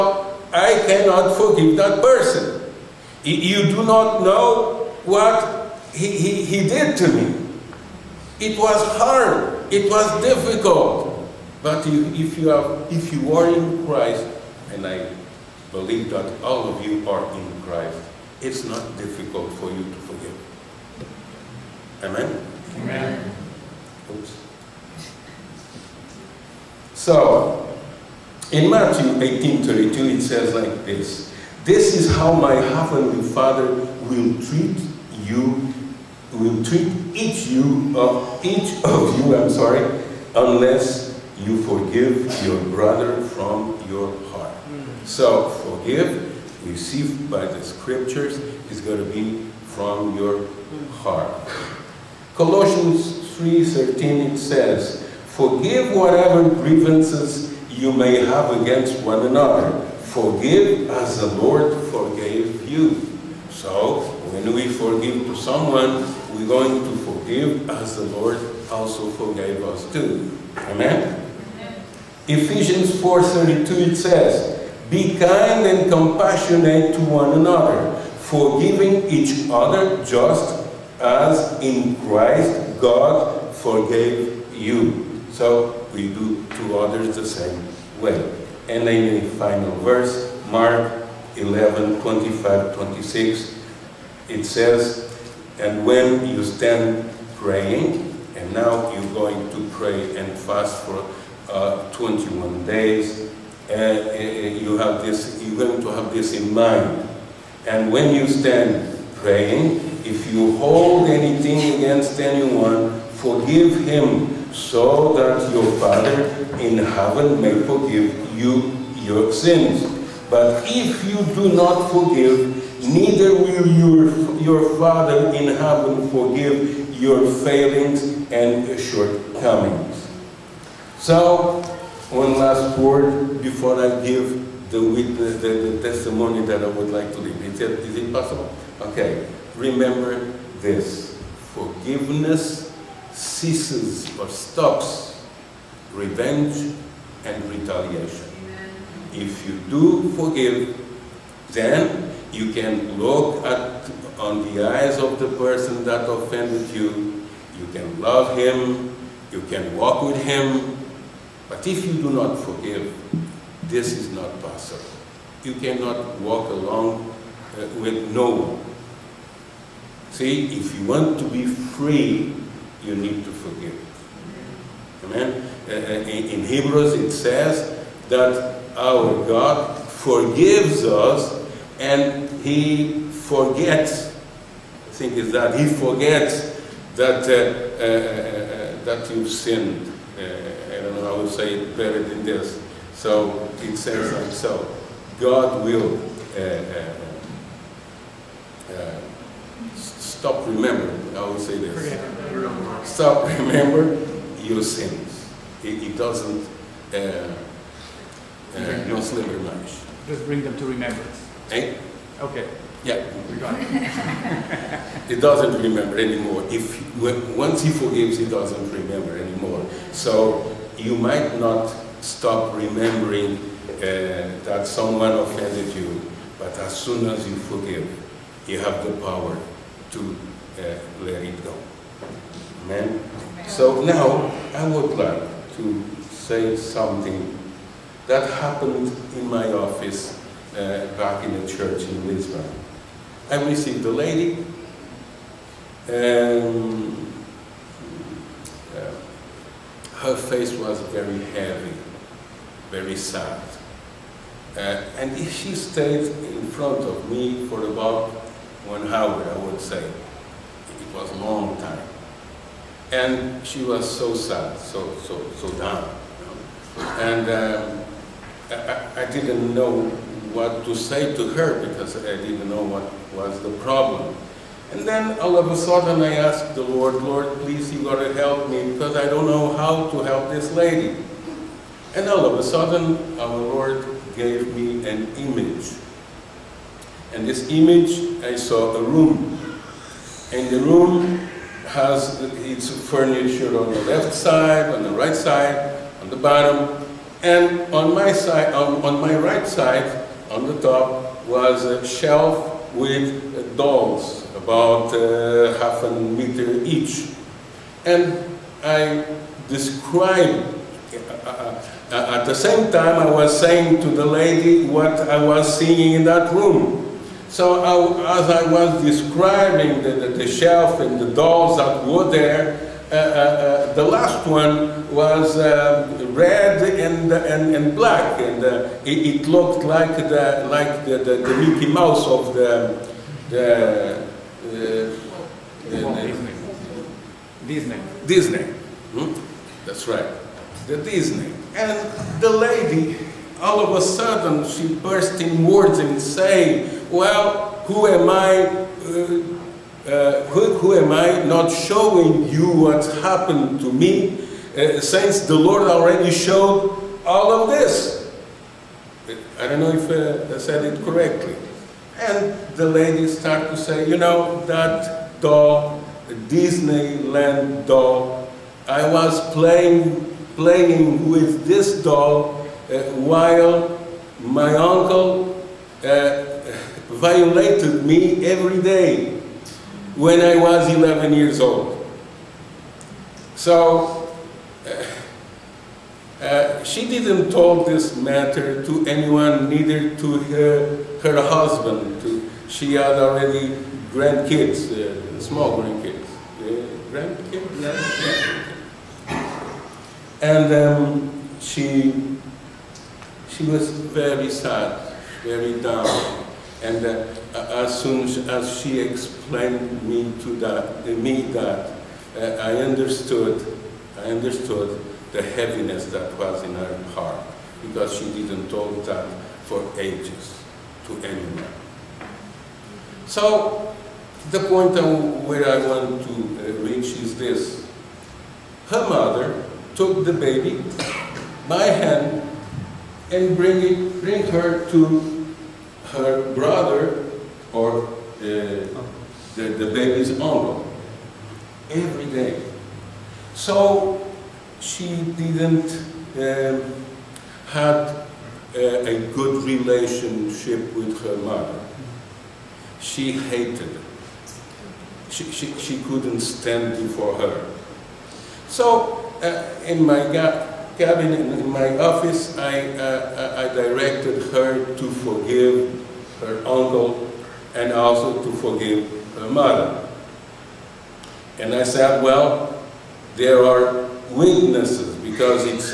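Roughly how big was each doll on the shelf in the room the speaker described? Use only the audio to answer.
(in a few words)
half a meter.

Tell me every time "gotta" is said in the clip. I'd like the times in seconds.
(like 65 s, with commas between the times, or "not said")
277 s.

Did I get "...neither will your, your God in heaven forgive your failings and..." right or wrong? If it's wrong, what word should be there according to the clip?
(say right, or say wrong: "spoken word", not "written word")
wrong: "Father", not "God".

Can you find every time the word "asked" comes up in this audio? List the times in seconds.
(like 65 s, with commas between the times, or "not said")
276 s.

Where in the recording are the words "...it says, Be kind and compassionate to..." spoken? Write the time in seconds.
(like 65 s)
73 s.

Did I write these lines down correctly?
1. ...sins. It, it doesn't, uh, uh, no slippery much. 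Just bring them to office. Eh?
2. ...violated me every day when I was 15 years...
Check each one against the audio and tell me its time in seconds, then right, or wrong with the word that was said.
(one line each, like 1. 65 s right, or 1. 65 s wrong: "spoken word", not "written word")
1. 204 s wrong: "remembrance", not "office"
2. 376 s wrong: "11", not "15".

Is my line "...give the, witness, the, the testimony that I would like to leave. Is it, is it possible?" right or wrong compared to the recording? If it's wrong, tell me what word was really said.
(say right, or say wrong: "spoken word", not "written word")
right.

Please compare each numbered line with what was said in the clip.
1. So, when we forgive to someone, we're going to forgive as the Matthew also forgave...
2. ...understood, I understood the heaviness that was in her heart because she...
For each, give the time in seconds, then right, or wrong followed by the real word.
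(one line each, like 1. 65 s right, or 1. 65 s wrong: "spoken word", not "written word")
1. 63 s wrong: "Lord", not "Matthew"
2. 412 s right.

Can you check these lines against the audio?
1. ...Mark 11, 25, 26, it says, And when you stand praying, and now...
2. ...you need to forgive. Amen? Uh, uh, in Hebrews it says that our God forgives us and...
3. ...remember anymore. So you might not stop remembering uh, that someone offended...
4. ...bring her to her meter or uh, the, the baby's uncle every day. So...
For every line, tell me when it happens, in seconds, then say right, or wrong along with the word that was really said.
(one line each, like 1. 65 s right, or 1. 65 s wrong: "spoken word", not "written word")
1. 90 s right
2. 172 s right
3. 218 s right
4. 434 s wrong: "brother", not "meter".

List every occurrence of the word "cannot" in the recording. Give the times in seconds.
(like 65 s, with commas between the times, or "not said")
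0 s, 165 s.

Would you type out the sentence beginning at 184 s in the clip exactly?
I think is that He forgets that, uh, uh, uh, that you sinned.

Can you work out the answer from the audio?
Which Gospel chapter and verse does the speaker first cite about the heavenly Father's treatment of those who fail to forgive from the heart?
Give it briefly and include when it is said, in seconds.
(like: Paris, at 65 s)
Matthew 18:32, at 28 s.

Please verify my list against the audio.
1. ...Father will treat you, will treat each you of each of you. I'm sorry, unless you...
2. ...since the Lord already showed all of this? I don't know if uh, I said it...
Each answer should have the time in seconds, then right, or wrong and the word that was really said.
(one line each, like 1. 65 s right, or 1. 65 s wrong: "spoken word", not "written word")
1. 33 s right
2. 354 s right.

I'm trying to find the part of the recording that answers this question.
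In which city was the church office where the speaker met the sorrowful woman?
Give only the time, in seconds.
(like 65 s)
242 s.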